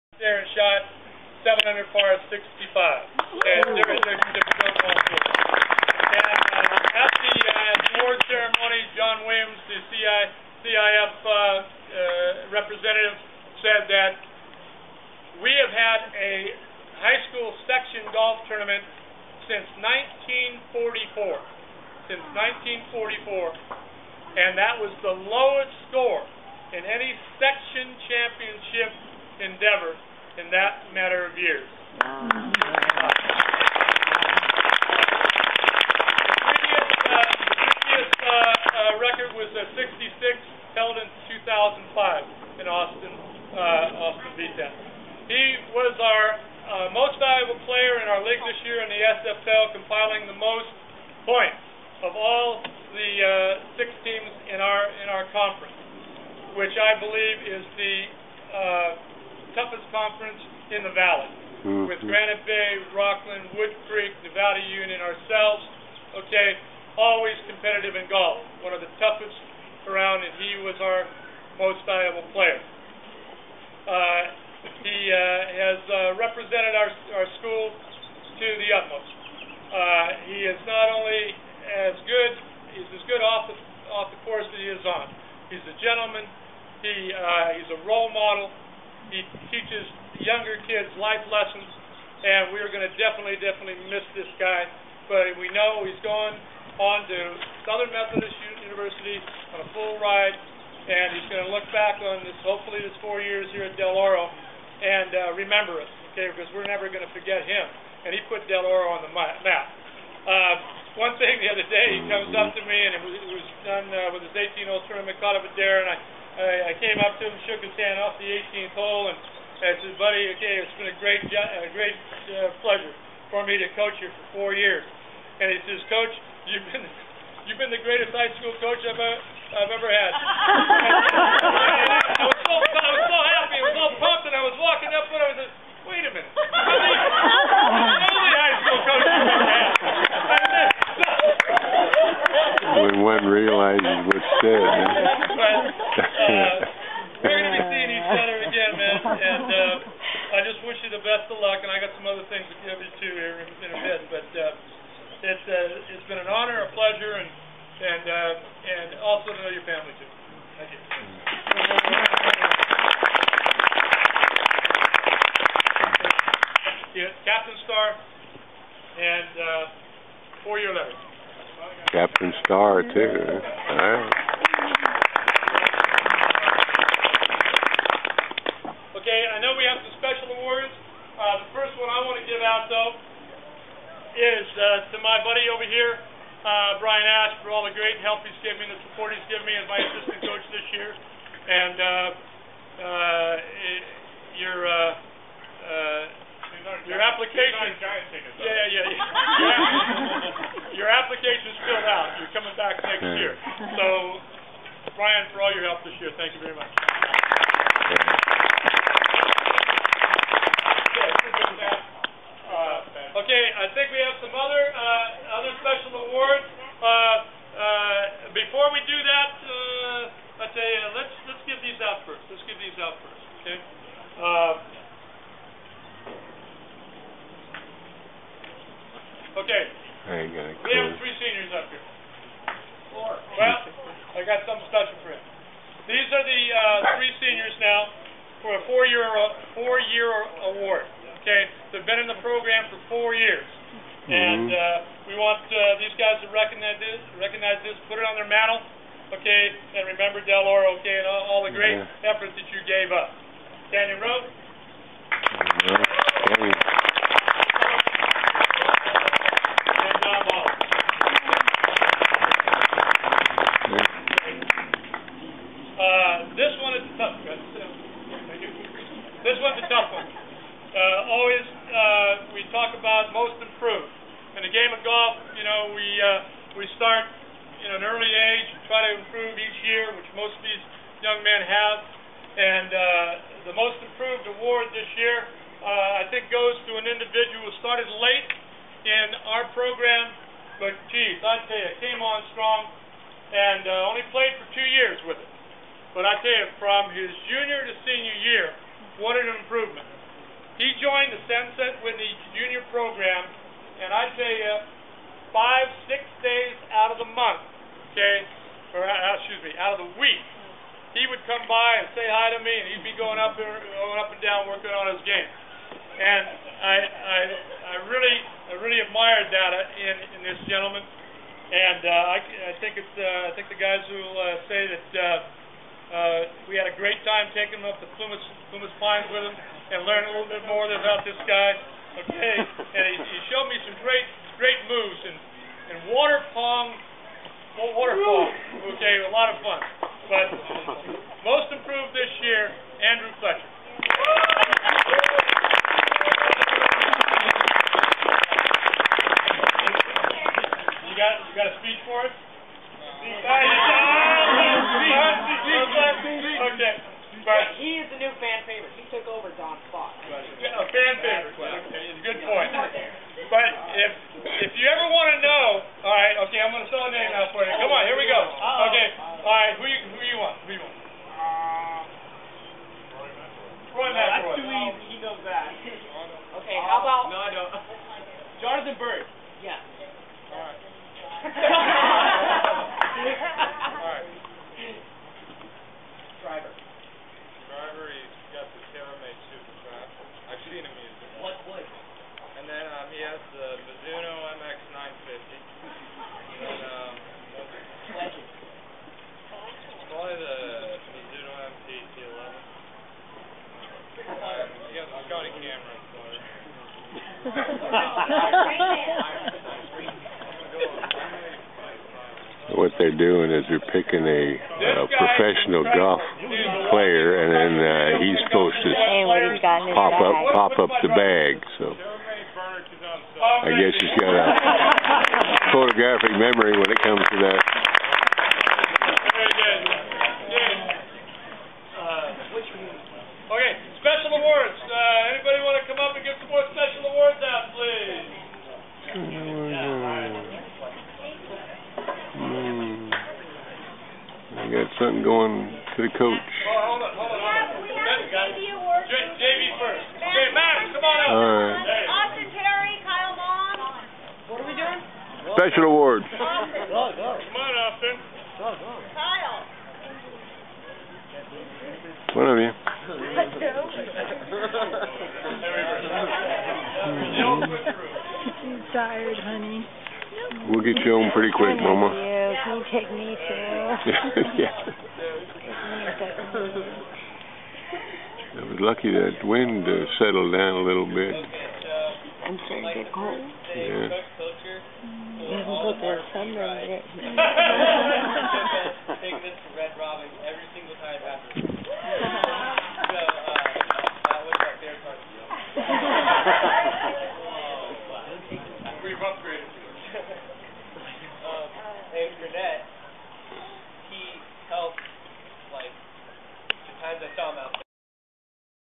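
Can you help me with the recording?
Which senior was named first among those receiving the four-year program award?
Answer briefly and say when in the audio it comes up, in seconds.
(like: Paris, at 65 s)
Daniel Rowe, at 253 s.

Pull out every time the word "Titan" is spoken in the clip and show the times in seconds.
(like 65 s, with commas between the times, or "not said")
not said.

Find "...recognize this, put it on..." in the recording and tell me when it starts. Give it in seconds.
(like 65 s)
247 s.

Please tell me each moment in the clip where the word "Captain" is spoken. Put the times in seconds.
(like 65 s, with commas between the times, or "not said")
167 s, 171 s.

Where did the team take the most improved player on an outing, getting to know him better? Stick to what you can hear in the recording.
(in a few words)
Plumas Pines.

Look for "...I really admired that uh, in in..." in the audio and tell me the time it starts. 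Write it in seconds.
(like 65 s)
318 s.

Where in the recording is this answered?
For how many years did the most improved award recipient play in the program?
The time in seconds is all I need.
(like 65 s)
294 s.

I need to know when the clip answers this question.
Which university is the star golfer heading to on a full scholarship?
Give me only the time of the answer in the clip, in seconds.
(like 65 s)
97 s.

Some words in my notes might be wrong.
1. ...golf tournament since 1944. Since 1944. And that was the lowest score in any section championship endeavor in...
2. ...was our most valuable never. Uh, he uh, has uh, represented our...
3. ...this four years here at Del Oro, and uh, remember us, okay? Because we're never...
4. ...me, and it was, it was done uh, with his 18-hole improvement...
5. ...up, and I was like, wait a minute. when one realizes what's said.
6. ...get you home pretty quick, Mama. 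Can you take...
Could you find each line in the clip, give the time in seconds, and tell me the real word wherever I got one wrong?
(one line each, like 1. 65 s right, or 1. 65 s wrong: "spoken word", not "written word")
1. 18 s right
2. 70 s wrong: "player", not "never"
3. 102 s right
4. 112 s wrong: "tournament", not "improvement"
5. 134 s right
6. 470 s right.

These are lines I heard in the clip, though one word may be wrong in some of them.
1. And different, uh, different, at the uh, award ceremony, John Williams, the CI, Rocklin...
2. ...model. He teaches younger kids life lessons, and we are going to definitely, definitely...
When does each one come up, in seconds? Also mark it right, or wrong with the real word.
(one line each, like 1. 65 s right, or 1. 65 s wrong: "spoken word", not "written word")
1. 2 s wrong: "CIF", not "Rocklin"
2. 88 s right.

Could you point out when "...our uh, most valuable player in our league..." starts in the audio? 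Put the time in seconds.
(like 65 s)
45 s.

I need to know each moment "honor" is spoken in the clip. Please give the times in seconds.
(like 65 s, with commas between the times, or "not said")
156 s.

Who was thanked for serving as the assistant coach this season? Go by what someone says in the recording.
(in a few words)
Brian Ash.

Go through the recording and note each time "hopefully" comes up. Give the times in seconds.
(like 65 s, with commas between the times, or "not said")
102 s.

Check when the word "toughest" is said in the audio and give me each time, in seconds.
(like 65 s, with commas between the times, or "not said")
59 s, 68 s.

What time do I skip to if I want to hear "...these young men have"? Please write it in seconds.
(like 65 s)
280 s.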